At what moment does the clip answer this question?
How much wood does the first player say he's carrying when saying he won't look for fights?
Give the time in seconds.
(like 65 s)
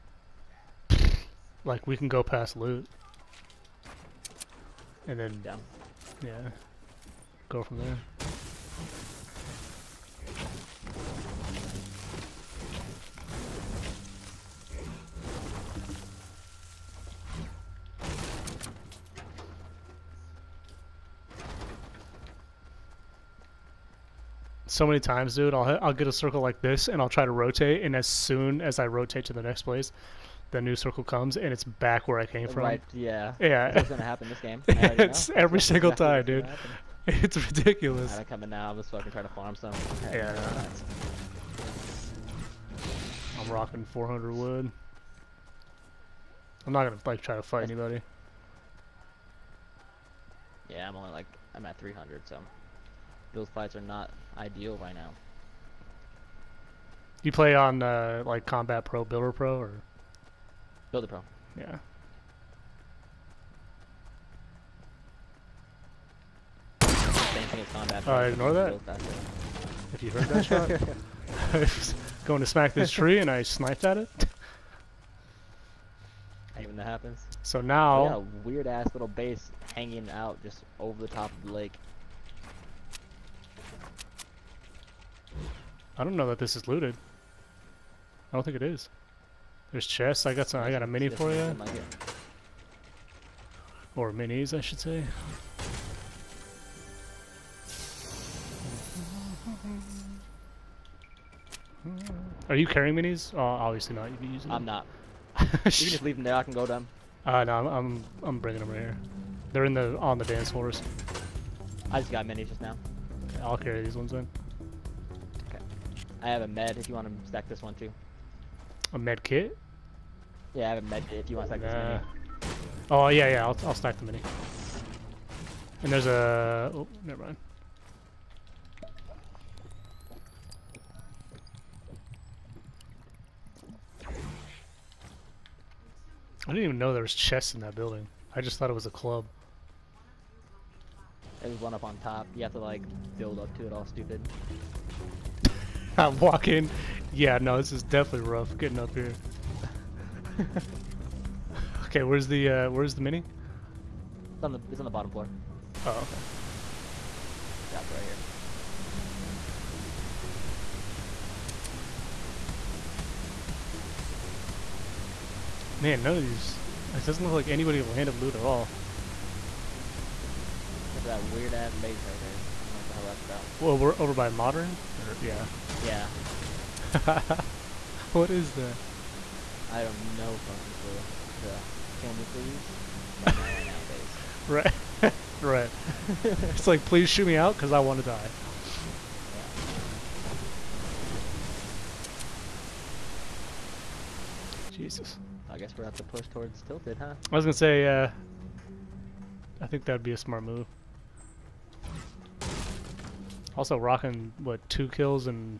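43 s.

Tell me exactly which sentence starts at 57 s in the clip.
You play on uh, like Combat Pro, Builder Pro, or?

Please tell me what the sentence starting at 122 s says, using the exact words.
Oh, yeah, yeah, I'll, I'll stack the mini.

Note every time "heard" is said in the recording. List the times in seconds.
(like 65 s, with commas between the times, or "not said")
70 s.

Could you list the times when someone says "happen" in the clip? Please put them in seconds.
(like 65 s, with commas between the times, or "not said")
34 s, 76 s.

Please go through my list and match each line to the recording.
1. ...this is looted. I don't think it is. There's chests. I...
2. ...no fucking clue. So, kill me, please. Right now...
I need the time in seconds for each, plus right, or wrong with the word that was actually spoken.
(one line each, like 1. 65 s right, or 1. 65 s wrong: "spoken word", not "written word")
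1. 86 s right
2. 179 s right.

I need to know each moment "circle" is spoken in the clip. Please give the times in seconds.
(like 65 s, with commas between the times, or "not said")
26 s, 30 s.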